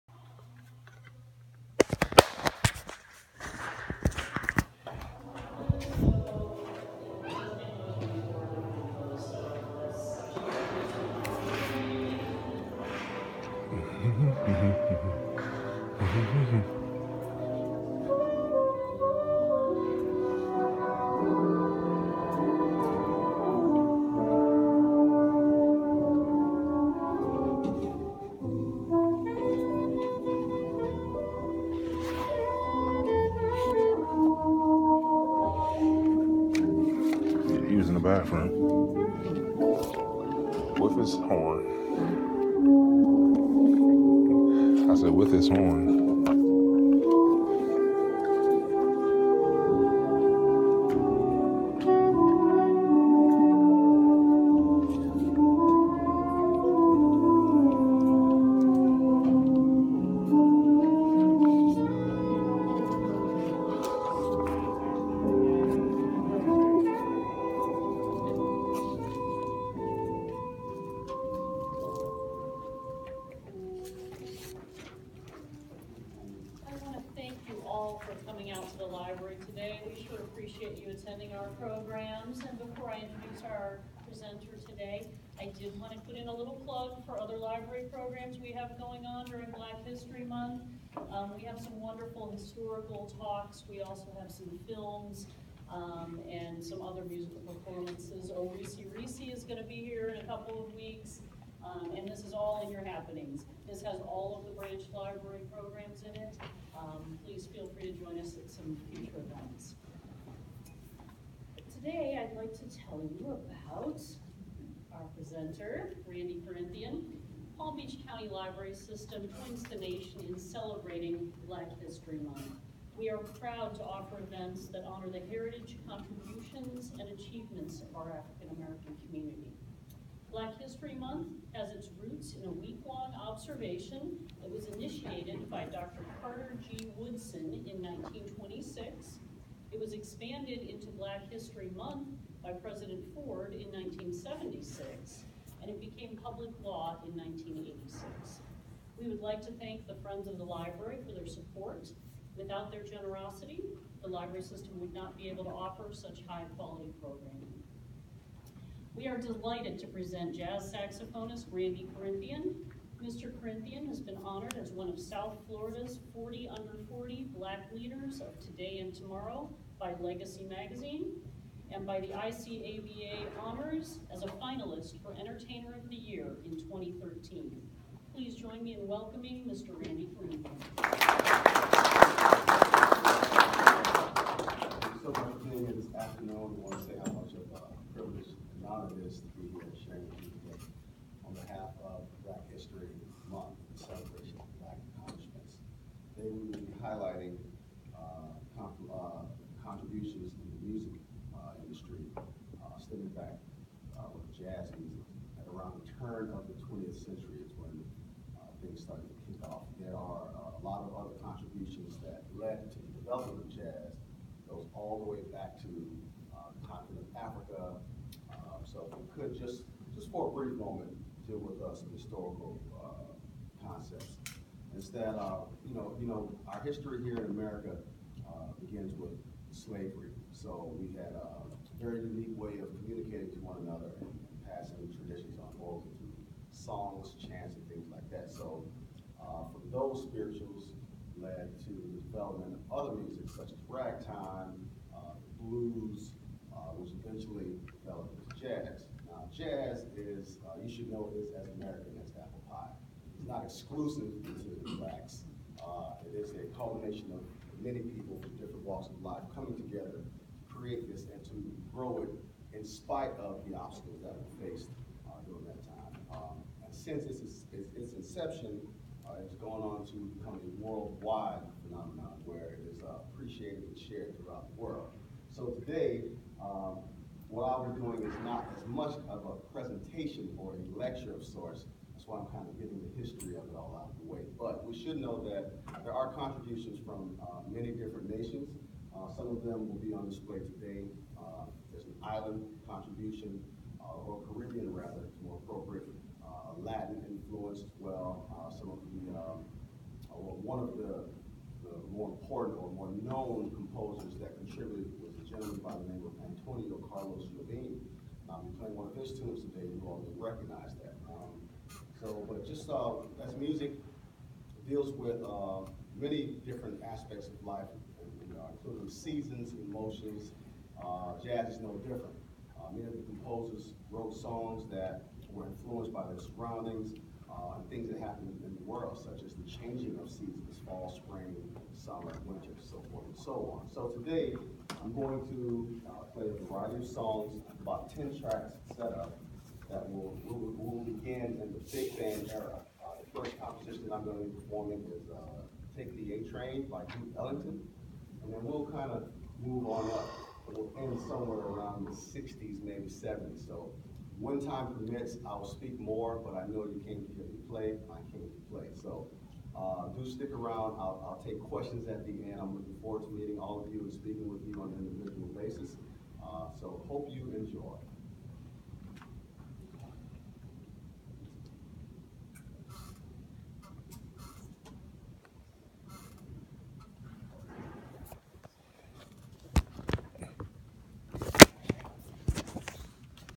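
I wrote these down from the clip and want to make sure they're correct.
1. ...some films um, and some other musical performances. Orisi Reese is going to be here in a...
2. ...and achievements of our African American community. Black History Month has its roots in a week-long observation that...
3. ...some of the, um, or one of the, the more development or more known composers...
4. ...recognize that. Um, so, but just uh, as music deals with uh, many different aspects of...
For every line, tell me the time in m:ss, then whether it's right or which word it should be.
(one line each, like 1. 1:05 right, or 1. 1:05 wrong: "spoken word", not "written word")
1. 1:34 right
2. 2:06 right
3. 4:58 wrong: "important", not "development"
4. 5:10 right.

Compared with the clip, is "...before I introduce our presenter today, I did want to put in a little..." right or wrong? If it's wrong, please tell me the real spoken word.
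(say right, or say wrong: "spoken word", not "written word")
right.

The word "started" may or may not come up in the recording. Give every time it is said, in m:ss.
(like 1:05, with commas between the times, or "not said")
3:28.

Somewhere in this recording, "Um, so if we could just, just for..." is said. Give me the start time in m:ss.
3:38.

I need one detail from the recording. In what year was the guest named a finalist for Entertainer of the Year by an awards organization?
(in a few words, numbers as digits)
2013.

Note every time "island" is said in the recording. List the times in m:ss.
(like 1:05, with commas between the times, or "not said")
4:52.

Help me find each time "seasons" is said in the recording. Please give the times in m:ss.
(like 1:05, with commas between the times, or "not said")
5:18, 5:30.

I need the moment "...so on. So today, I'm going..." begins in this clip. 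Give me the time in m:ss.
5:33.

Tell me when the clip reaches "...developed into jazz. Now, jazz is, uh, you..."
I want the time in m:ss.
4:07.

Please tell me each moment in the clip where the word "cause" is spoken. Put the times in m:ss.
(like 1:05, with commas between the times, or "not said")
not said.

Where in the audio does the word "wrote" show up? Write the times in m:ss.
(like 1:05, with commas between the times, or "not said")
5:23.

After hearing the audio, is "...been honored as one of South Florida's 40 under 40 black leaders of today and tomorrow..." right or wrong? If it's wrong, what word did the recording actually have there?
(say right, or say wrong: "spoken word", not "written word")
right.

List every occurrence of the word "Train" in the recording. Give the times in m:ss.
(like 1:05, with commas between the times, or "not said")
5:46.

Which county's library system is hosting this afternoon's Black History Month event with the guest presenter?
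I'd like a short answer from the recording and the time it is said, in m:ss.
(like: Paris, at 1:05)
Palm Beach County, at 1:57.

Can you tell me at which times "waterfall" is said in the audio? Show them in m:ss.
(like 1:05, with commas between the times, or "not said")
not said.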